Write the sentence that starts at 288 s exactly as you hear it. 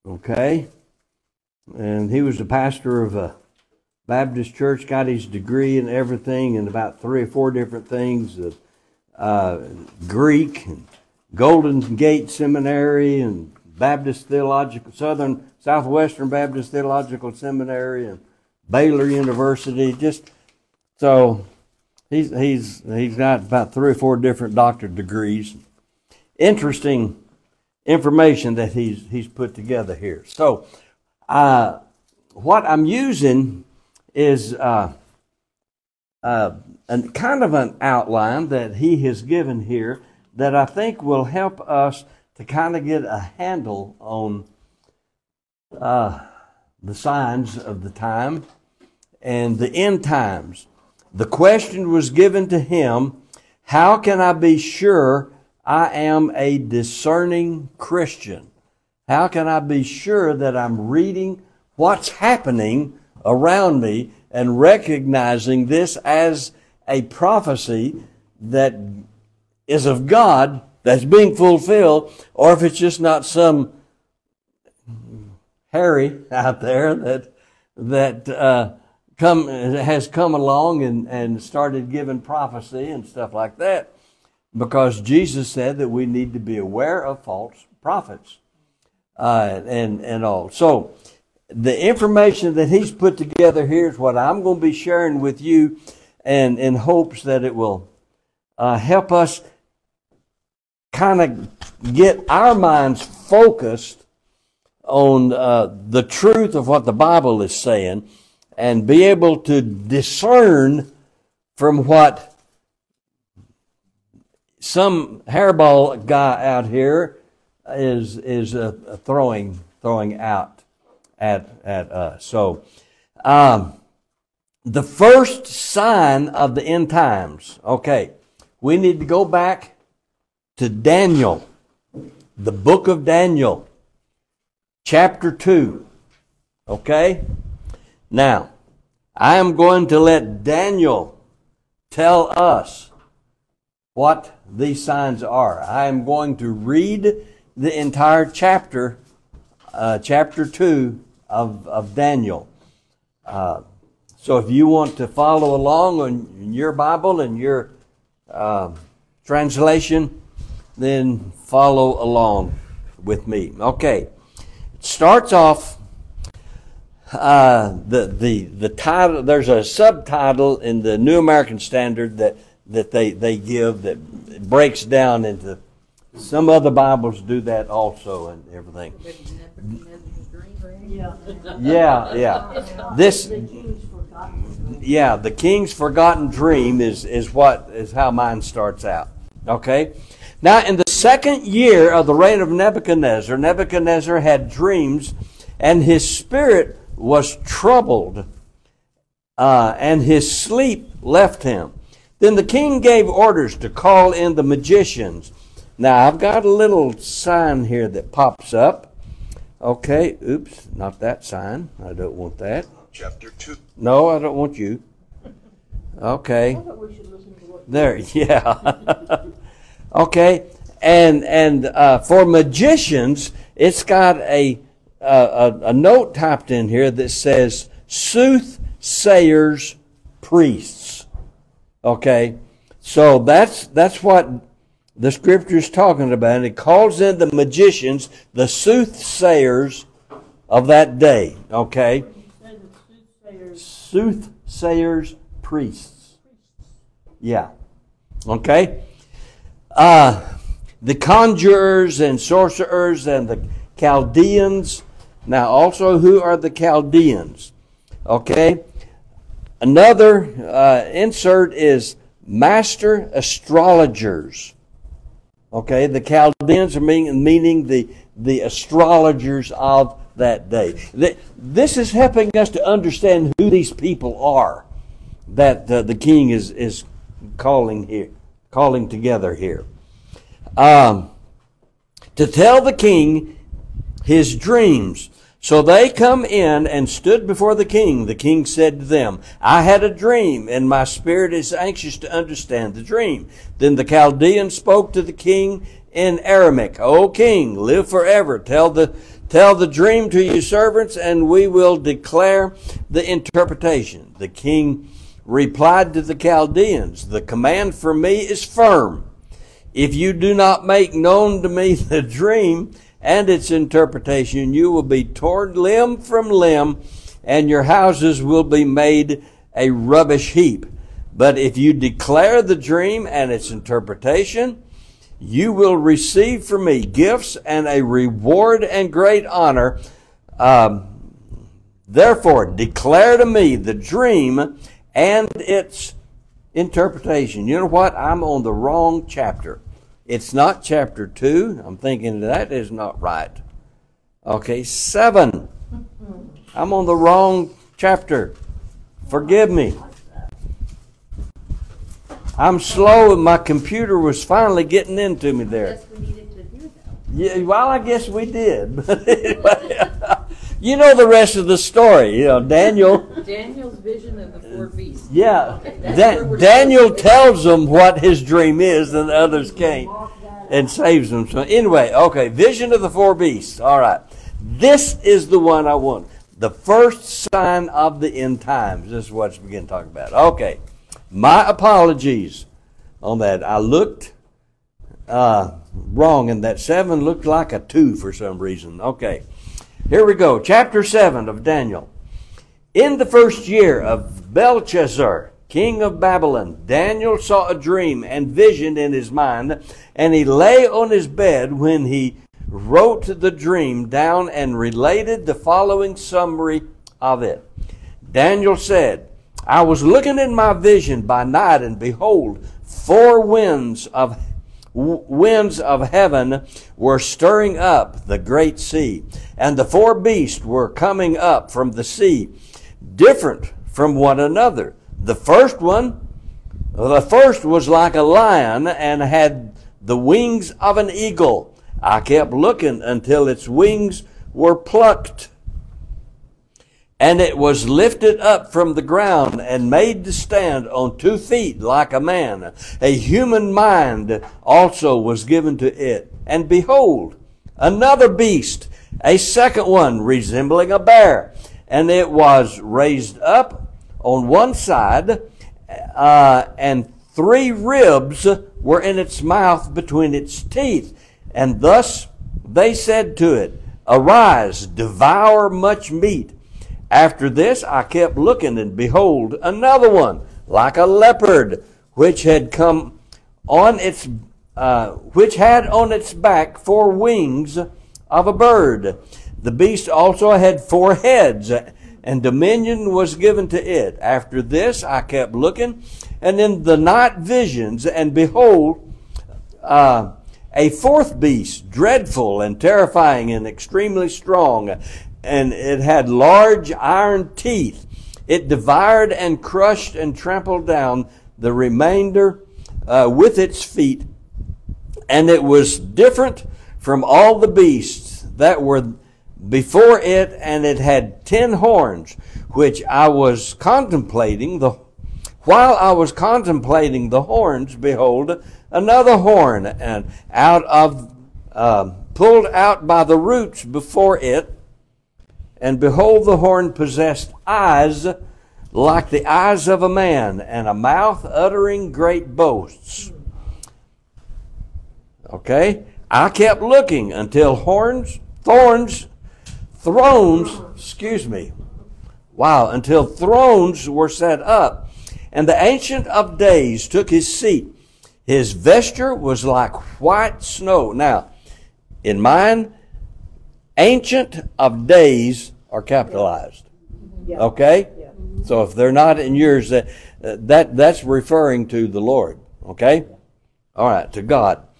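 The king said to them, I had a dream, and my spirit is anxious to understand the dream.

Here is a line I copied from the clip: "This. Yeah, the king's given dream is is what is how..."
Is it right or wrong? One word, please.
wrong.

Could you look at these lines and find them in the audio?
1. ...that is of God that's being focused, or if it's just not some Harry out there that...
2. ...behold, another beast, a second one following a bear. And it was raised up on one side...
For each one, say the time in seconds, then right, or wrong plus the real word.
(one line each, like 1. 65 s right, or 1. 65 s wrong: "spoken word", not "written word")
1. 68 s wrong: "fulfilled", not "focused"
2. 446 s wrong: "resembling", not "following".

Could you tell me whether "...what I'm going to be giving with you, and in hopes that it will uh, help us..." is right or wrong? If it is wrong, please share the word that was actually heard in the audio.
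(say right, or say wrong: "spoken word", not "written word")
wrong: "sharing", not "giving".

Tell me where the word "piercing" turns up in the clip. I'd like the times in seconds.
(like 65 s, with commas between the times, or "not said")
not said.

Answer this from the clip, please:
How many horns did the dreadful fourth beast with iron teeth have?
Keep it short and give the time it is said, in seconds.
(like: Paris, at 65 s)
10, at 511 s.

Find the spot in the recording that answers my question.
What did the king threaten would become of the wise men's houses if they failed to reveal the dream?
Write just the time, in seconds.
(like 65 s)
319 s.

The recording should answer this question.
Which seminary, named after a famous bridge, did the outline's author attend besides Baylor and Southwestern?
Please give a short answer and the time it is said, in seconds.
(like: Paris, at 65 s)
Golden Gate Seminary, at 11 s.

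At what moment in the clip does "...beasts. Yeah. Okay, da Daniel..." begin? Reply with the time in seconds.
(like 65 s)
364 s.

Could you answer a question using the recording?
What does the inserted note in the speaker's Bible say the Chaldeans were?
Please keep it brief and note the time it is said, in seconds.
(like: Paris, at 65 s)
master astrologers, at 262 s.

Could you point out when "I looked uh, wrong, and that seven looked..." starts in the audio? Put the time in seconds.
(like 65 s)
383 s.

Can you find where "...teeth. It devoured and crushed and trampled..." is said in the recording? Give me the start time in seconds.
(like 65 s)
497 s.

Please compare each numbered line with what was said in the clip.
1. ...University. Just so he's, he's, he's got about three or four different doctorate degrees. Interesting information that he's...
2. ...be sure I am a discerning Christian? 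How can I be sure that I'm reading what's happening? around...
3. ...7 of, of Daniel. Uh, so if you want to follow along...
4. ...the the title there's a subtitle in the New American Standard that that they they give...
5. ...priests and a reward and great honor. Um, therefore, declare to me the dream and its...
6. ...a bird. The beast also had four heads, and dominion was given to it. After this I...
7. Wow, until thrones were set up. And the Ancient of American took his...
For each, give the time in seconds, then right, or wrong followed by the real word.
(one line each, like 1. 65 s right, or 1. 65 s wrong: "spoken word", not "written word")
1. 19 s right
2. 54 s right
3. 150 s wrong: "2", not "7"
4. 168 s right
5. 326 s wrong: "gifts", not "priests"
6. 478 s right
7. 542 s wrong: "Days", not "American".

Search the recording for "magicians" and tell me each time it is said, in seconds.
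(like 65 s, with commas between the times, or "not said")
204 s, 222 s, 237 s.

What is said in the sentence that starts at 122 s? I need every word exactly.
So, um, the first sign of the end times.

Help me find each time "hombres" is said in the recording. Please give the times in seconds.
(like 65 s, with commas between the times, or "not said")
not said.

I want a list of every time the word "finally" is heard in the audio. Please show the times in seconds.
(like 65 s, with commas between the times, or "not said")
354 s.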